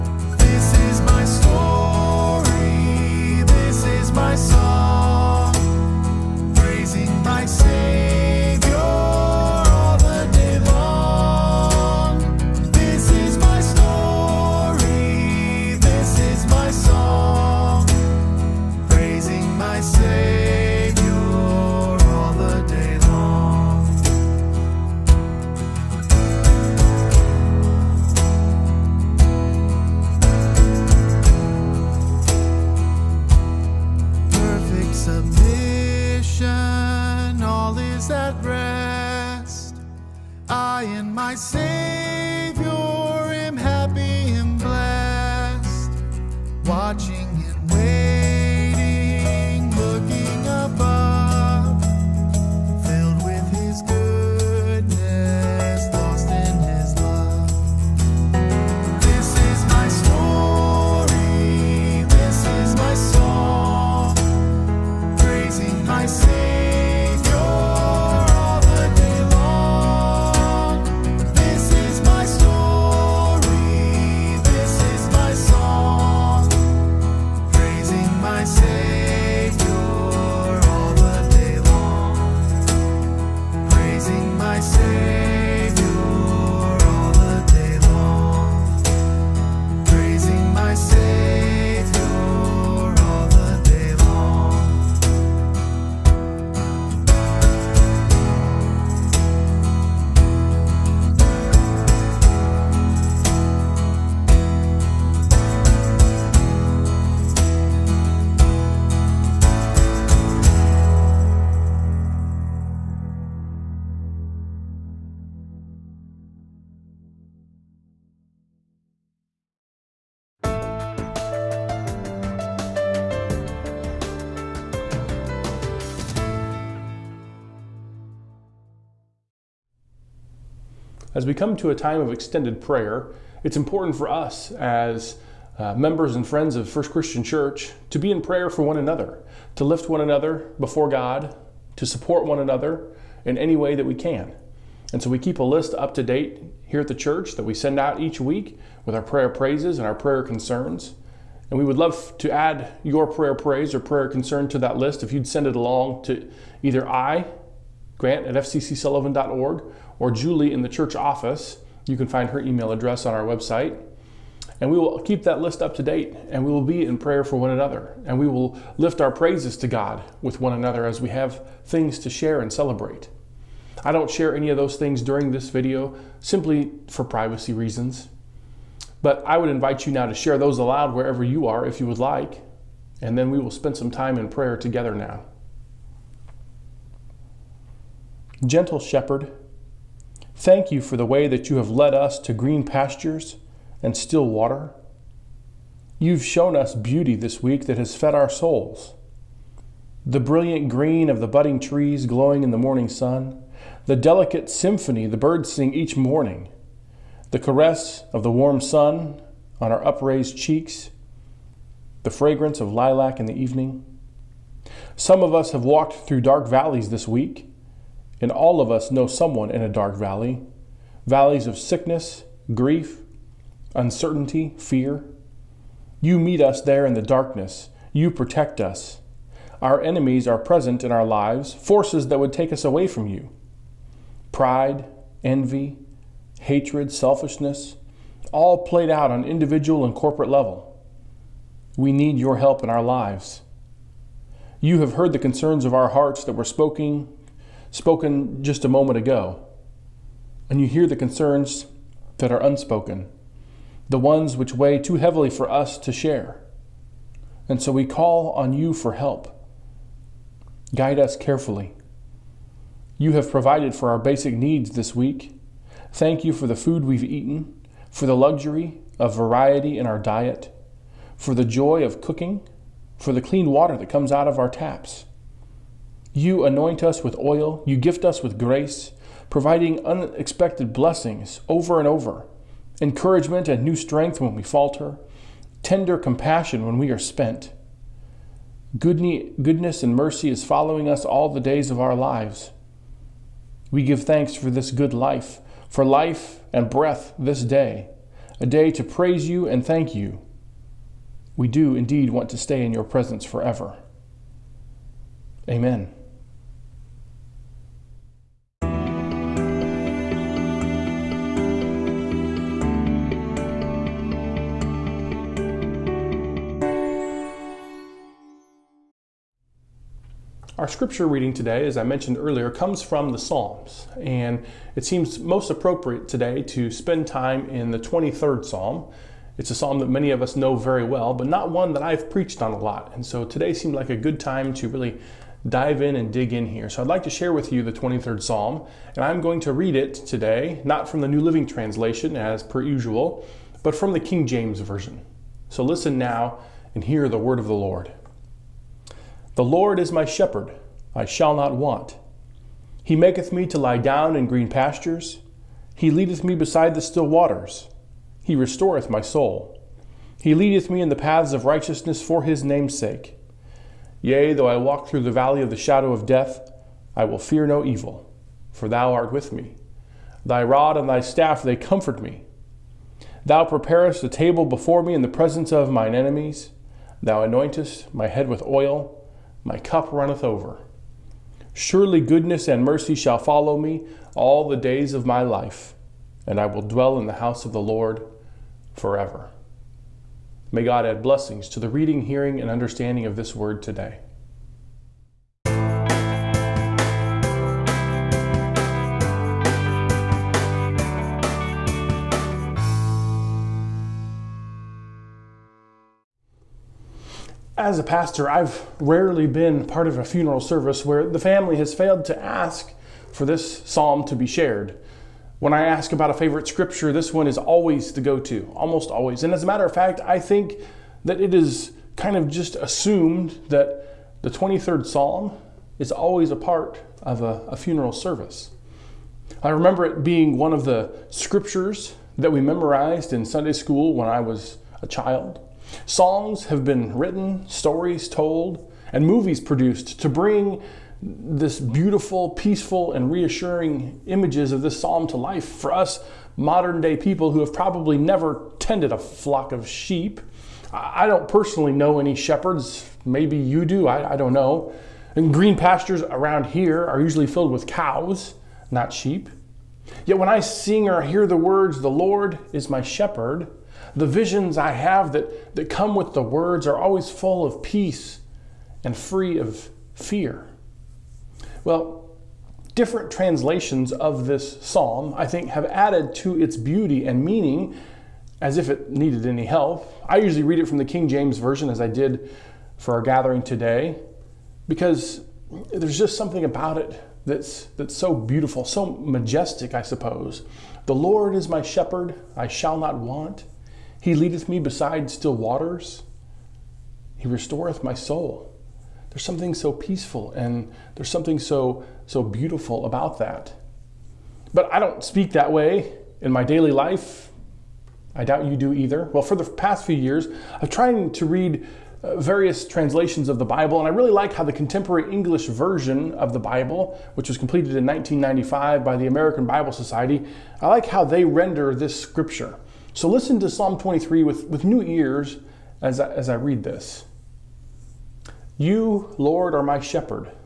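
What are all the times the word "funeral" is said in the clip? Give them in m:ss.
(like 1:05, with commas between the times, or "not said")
6:50, 7:07.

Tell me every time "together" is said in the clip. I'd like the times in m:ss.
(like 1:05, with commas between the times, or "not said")
3:04.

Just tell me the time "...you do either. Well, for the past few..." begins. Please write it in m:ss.
8:28.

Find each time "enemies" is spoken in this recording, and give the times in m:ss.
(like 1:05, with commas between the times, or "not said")
3:49, 6:15.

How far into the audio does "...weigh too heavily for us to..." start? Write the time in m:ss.
4:14.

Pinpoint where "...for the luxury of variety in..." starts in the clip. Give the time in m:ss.
4:27.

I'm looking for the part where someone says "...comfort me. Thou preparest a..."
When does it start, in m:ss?
6:11.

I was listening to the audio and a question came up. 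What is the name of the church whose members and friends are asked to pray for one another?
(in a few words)
First Christian Church.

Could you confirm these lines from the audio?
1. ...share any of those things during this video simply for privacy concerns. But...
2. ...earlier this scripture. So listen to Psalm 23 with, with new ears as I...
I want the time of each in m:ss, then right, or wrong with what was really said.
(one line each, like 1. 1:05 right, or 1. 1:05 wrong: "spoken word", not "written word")
1. 2:54 wrong: "reasons", not "concerns"
2. 8:41 wrong: "render", not "earlier".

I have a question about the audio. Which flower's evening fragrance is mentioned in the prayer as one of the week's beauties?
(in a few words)
Lilac.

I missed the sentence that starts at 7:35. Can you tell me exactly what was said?
And green pastures around here are usually filled with cows, not sheep.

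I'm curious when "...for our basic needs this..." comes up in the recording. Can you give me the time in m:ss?
4:23.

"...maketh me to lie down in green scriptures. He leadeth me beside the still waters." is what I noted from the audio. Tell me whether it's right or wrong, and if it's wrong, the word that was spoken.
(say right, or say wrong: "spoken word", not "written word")
wrong: "pastures", not "scriptures".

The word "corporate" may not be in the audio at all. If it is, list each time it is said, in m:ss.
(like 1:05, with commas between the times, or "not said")
3:59.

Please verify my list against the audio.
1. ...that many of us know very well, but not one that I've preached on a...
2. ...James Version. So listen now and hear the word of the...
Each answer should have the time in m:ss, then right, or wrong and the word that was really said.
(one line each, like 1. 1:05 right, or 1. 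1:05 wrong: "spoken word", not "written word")
1. 5:29 right
2. 5:44 right.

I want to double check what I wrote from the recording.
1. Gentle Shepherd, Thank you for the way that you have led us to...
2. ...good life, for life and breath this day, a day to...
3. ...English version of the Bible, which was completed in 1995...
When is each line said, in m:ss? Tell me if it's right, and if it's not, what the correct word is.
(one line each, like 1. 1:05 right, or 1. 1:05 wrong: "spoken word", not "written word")
1. 3:08 right
2. 4:54 right
3. 8:35 right.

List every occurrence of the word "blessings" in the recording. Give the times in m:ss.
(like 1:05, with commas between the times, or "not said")
4:40, 6:31.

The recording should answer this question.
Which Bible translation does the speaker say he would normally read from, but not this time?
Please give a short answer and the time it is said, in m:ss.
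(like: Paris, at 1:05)
New Living Translation, at 5:41.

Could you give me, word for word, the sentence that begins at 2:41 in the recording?
You can find her email address on our website.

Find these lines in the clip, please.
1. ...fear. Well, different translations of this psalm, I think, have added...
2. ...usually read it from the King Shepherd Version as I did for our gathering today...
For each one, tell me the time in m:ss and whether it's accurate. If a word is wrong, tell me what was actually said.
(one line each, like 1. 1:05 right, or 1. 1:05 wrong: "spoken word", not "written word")
1. 7:49 right
2. 8:00 wrong: "James", not "Shepherd".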